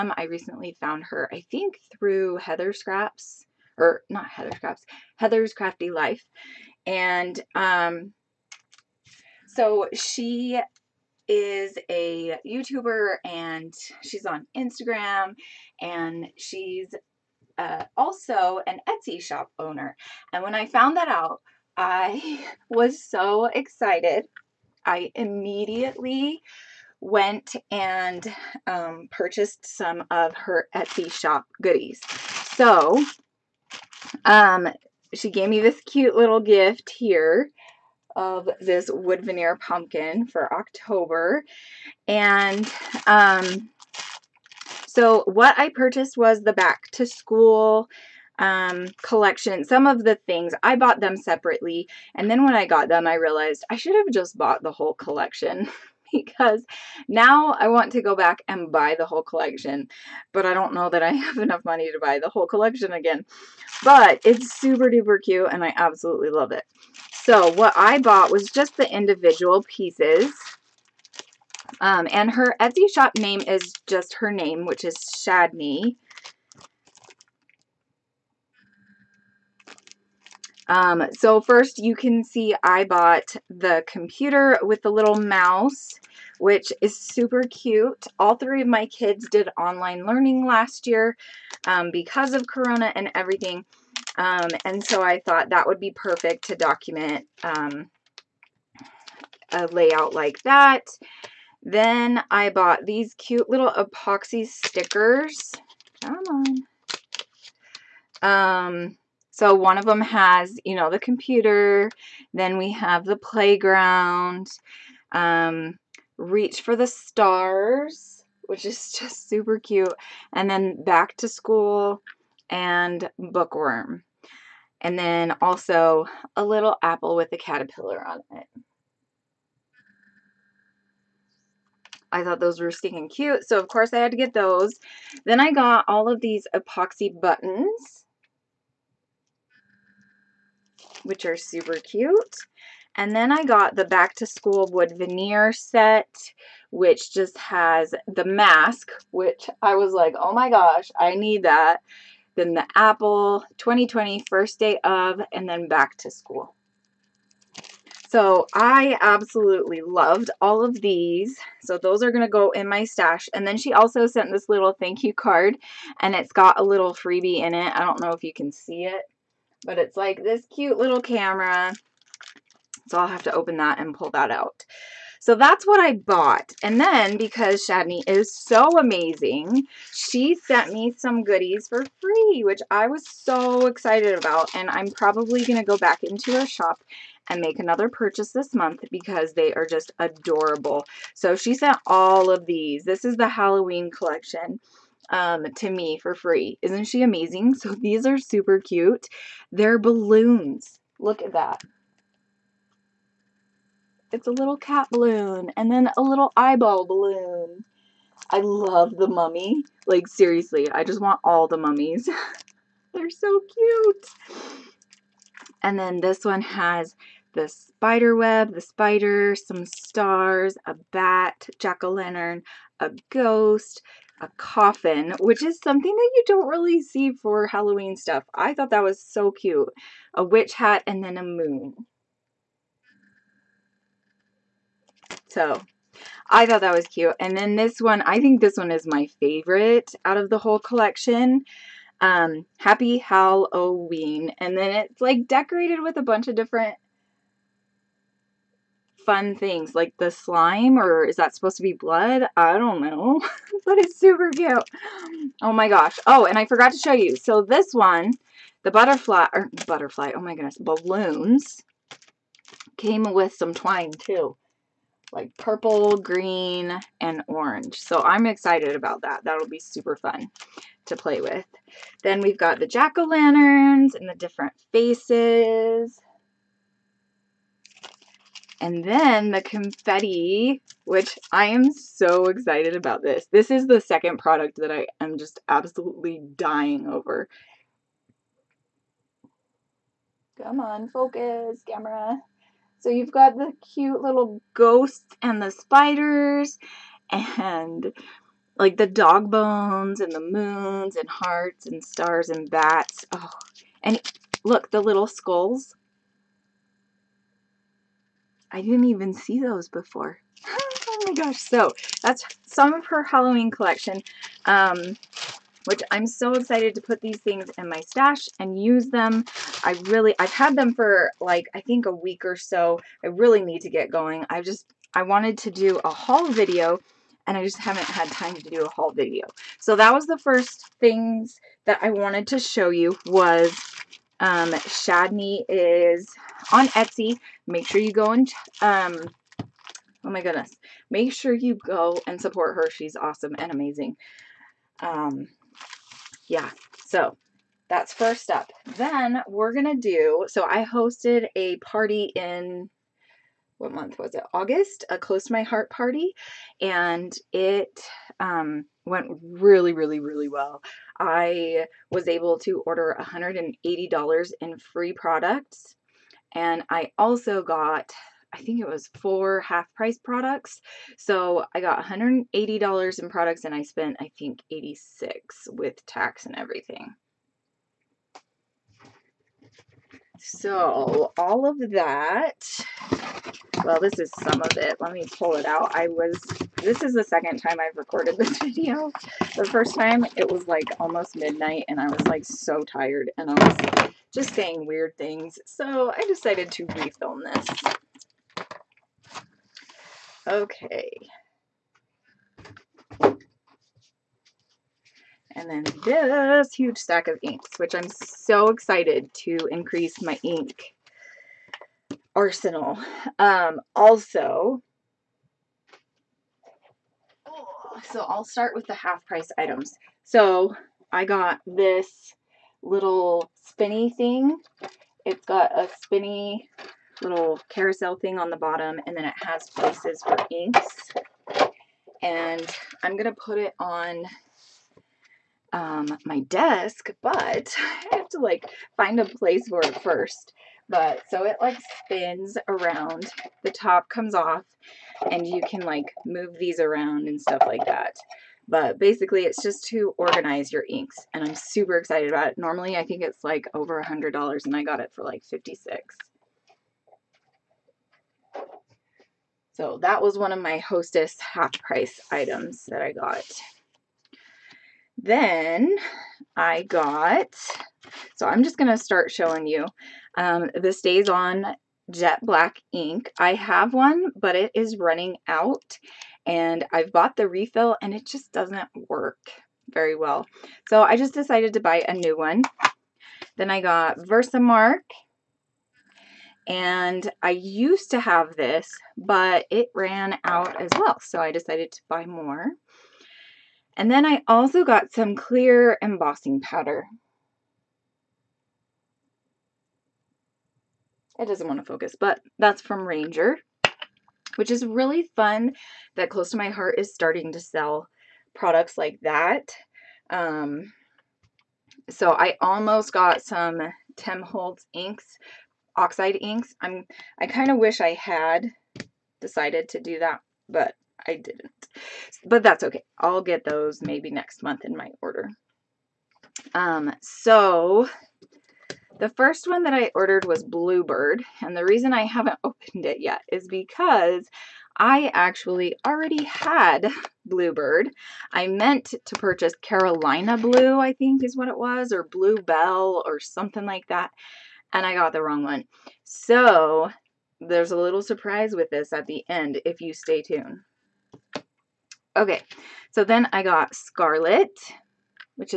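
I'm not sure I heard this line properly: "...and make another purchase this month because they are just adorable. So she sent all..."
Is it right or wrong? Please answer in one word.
right.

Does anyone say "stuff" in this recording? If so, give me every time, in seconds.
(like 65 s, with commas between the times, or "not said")
227 s, 447 s.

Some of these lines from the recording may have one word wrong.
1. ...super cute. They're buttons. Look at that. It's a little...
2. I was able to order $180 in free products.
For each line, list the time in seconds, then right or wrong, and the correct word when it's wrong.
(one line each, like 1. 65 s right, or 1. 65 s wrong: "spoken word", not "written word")
1. 198 s wrong: "balloons", not "buttons"
2. 360 s right.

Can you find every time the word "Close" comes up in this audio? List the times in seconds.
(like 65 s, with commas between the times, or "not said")
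354 s, 506 s.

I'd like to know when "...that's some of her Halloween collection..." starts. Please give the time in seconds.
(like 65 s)
312 s.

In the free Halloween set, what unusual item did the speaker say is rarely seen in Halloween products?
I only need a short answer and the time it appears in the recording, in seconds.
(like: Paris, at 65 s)
coffin, at 224 s.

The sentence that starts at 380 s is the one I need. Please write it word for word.
So all of that, well, this is some of it.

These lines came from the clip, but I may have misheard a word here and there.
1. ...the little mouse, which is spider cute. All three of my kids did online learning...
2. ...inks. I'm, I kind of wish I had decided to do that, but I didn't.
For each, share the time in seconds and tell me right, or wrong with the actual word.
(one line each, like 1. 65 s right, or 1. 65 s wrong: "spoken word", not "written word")
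1. 84 s wrong: "super", not "spider"
2. 516 s right.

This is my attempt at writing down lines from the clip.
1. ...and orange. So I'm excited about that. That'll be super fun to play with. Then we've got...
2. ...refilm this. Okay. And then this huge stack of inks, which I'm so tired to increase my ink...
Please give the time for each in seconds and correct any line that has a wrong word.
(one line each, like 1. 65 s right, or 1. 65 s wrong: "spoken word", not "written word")
1. 266 s right
2. 396 s wrong: "excited", not "tired".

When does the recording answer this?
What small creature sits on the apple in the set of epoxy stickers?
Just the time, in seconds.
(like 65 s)
127 s.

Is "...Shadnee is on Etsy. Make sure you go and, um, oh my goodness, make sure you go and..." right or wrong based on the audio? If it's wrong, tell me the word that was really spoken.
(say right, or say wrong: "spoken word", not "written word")
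right.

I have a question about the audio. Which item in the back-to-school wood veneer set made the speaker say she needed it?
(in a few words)
mask.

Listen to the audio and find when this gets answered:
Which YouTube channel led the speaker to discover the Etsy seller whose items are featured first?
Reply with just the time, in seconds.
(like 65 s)
5 s.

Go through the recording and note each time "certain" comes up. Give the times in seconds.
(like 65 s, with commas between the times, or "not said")
not said.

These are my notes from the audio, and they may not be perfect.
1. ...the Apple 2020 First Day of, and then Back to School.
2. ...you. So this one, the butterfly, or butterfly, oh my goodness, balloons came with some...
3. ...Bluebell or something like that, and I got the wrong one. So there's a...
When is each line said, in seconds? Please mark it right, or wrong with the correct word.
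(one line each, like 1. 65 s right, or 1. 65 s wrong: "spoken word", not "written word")
1. 152 s right
2. 256 s right
3. 542 s right.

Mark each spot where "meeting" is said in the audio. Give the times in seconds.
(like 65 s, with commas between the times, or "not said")
not said.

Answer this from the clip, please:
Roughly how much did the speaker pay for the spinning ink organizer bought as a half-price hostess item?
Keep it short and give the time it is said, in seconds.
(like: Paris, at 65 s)
56, at 455 s.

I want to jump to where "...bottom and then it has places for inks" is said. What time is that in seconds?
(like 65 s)
428 s.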